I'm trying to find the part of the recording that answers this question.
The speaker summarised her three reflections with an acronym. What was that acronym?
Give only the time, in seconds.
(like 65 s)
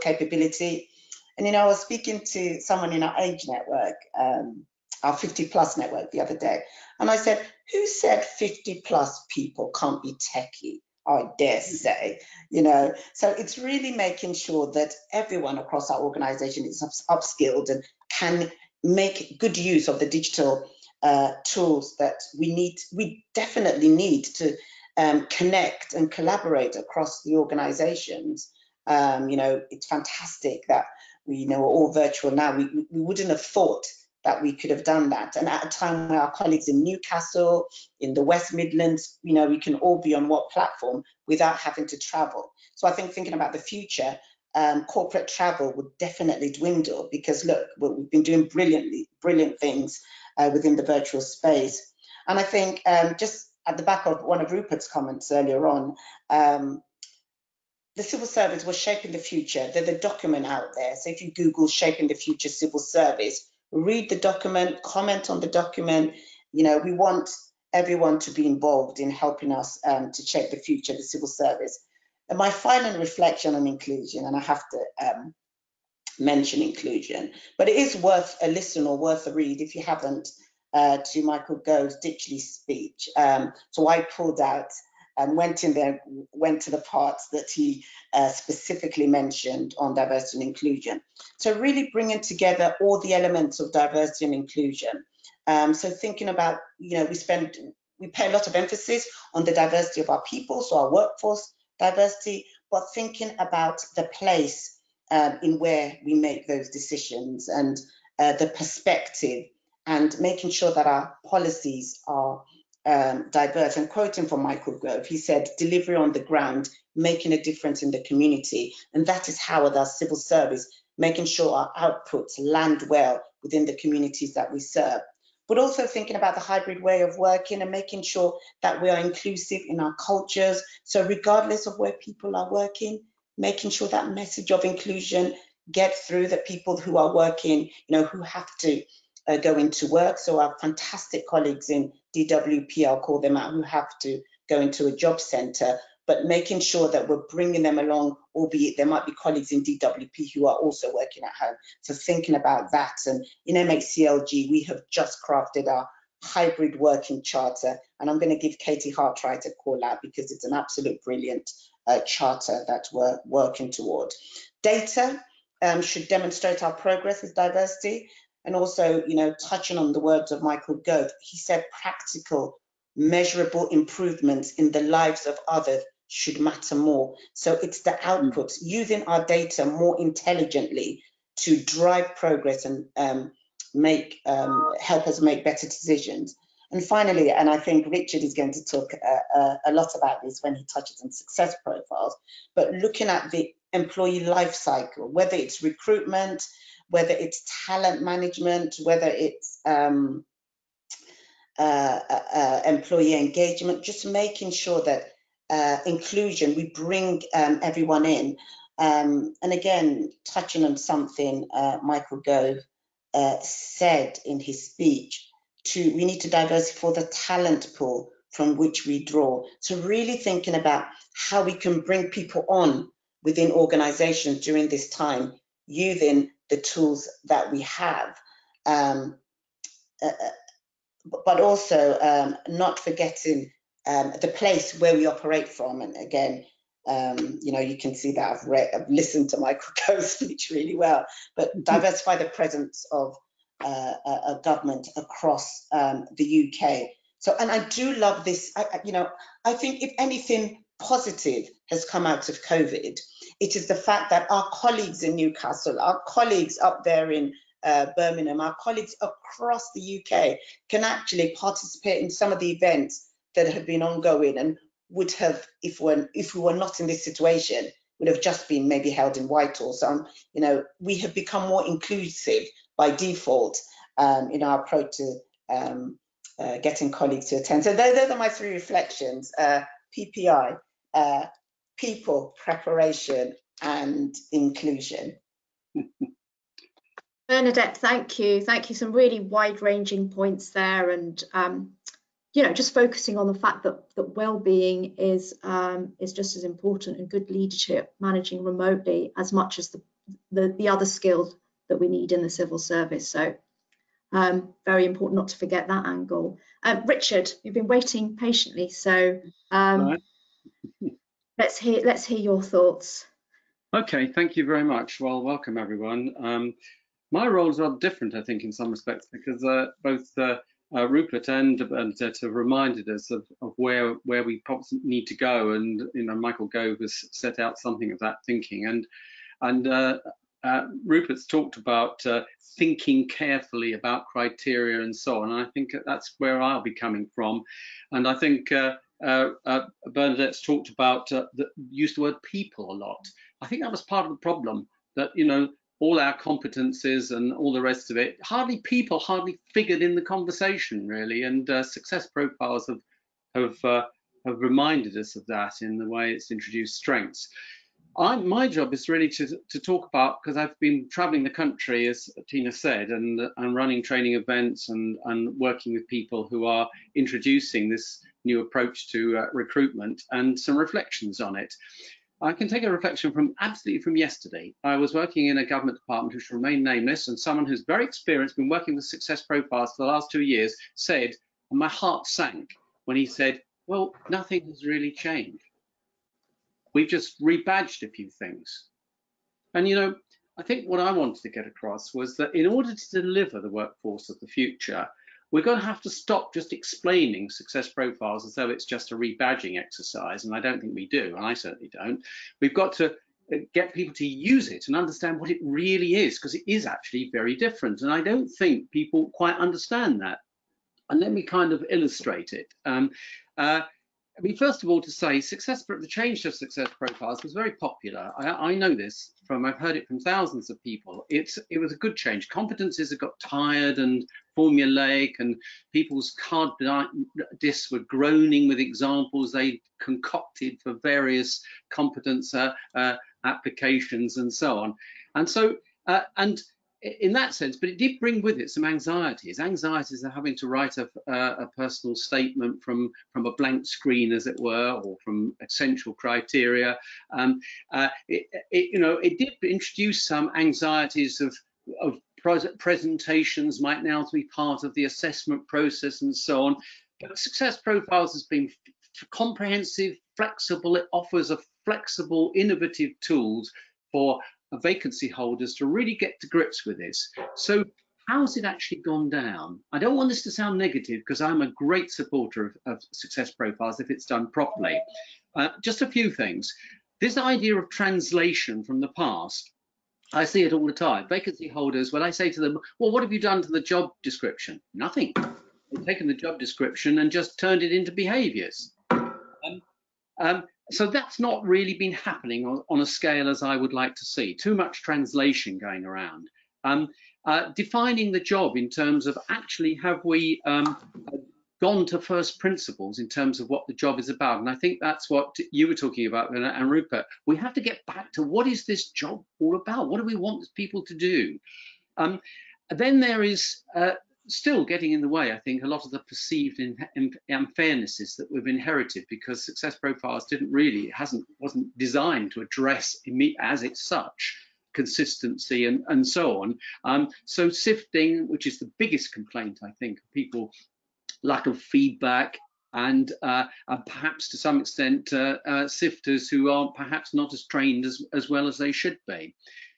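279 s.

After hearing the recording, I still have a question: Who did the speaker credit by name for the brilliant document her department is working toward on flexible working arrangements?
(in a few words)
Katie Hartwright.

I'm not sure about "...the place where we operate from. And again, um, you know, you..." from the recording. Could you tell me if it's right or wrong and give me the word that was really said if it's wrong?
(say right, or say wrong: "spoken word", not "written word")
right.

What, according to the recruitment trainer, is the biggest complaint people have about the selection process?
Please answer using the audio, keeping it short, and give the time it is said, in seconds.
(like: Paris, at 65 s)
sifting, at 527 s.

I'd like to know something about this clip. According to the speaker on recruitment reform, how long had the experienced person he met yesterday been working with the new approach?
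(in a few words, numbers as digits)
2 years.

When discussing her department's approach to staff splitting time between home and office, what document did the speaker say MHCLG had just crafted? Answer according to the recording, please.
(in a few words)
hybrid working charter.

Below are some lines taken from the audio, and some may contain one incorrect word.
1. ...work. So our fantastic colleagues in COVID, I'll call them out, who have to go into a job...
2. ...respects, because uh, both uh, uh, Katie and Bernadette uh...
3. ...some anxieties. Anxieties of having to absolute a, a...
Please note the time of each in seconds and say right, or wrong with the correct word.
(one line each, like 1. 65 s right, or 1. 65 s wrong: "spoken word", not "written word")
1. 139 s wrong: "DWP", not "COVID"
2. 318 s wrong: "Rupert", not "Katie"
3. 438 s wrong: "write", not "absolute".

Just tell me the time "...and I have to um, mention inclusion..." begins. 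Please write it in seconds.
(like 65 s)
74 s.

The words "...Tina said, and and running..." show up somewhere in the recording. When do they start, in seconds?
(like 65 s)
362 s.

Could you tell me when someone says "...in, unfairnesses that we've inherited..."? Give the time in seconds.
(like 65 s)
516 s.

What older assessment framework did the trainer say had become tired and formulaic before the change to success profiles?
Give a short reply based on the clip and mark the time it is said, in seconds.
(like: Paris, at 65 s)
competencies, at 422 s.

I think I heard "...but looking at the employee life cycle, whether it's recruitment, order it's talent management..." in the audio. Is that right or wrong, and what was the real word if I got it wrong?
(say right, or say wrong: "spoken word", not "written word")
wrong: "whether", not "order".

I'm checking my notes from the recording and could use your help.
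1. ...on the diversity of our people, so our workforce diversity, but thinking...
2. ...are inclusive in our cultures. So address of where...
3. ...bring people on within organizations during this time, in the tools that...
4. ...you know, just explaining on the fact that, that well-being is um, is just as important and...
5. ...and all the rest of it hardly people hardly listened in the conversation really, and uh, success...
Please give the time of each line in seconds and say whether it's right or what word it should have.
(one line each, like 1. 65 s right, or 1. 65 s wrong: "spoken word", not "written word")
1. 99 s right
2. 128 s wrong: "regardless", not "address"
3. 221 s right
4. 292 s wrong: "focusing", not "explaining"
5. 347 s wrong: "figured", not "listened".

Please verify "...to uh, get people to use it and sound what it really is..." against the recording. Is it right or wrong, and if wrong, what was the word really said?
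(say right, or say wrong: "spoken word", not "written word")
wrong: "understand", not "sound".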